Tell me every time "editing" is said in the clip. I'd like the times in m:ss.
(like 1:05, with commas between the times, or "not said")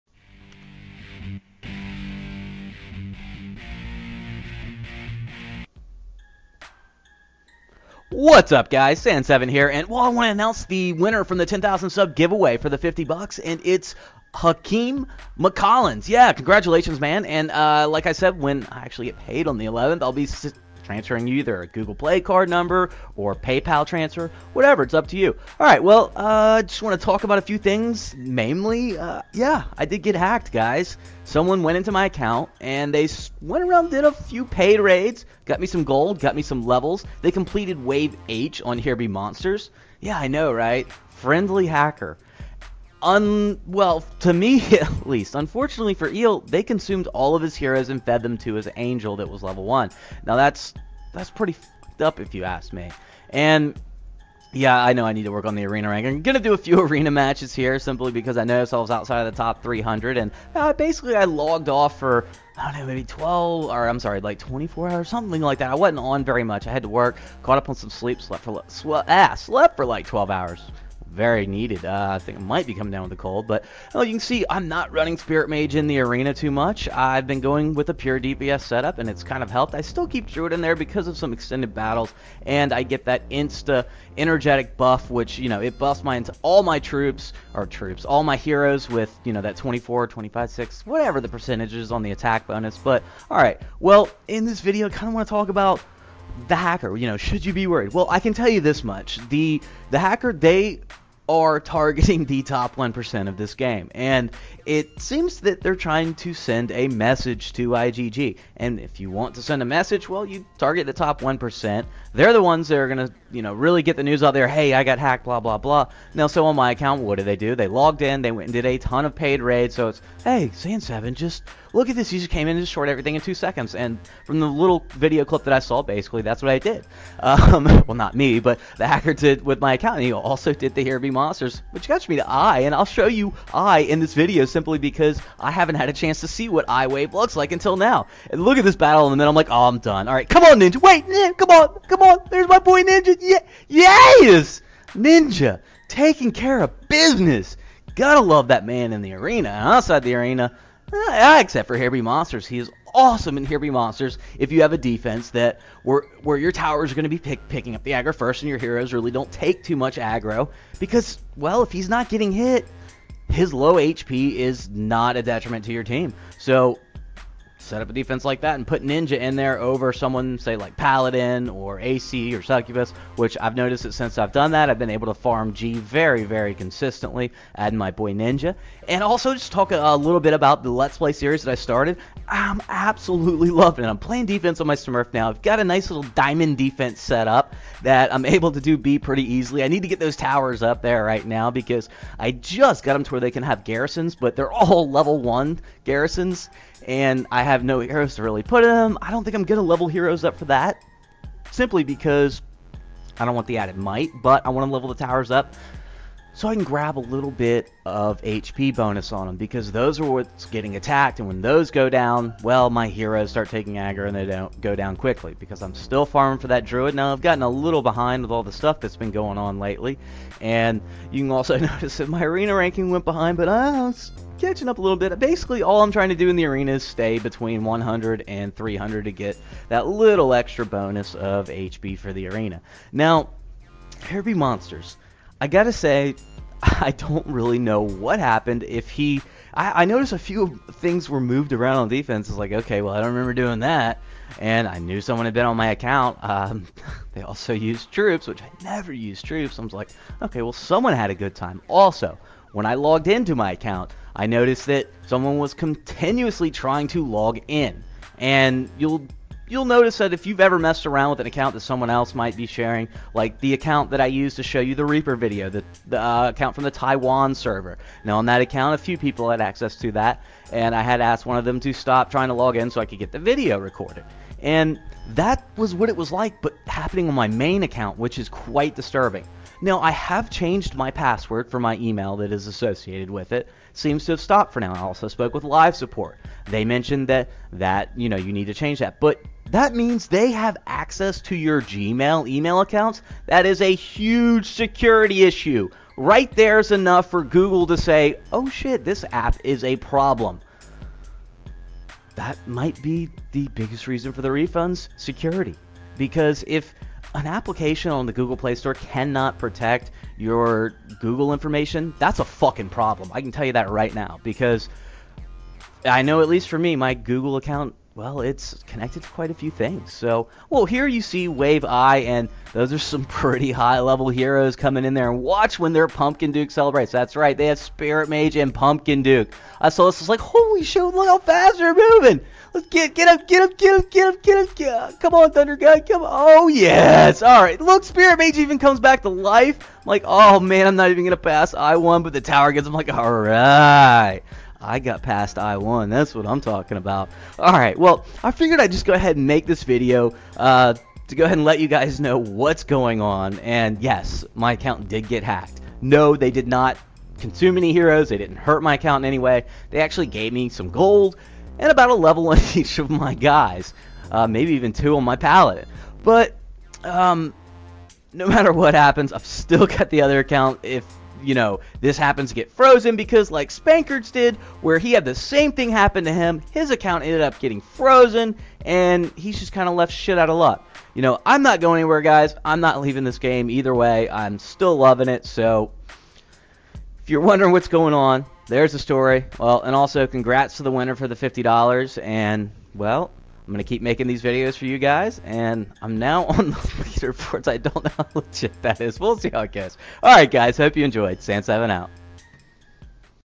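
not said.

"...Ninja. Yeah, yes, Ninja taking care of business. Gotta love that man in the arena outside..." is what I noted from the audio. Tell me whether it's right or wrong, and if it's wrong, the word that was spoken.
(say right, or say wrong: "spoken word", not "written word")
right.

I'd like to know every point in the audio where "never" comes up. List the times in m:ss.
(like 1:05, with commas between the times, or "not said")
4:08.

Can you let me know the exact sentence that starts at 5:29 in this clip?
I saw this, is like, holy shit, look how fast they're moving.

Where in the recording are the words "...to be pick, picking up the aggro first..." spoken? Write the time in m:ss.
2:37.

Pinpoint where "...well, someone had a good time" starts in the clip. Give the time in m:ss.
4:10.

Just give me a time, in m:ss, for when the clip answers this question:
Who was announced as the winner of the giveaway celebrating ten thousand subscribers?
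0:14.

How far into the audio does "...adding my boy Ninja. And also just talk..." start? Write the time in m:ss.
2:57.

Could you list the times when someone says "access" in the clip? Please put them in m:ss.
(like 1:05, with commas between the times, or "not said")
4:29, 4:50.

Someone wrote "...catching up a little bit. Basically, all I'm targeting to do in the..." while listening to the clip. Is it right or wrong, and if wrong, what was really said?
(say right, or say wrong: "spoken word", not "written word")
wrong: "trying", not "targeting".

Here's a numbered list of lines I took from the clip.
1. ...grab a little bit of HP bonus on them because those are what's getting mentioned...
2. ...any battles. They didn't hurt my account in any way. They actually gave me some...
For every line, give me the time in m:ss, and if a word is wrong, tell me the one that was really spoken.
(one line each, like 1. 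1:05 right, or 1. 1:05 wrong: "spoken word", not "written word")
1. 3:26 wrong: "attacked", not "mentioned"
2. 5:57 wrong: "heroes", not "battles".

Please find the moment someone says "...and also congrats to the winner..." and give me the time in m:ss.
6:29.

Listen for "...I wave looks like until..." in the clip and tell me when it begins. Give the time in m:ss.
2:16.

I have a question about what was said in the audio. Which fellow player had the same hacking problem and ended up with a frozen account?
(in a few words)
Spankards.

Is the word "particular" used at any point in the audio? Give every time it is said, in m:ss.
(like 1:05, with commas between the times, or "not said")
not said.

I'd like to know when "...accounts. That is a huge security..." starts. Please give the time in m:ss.
4:52.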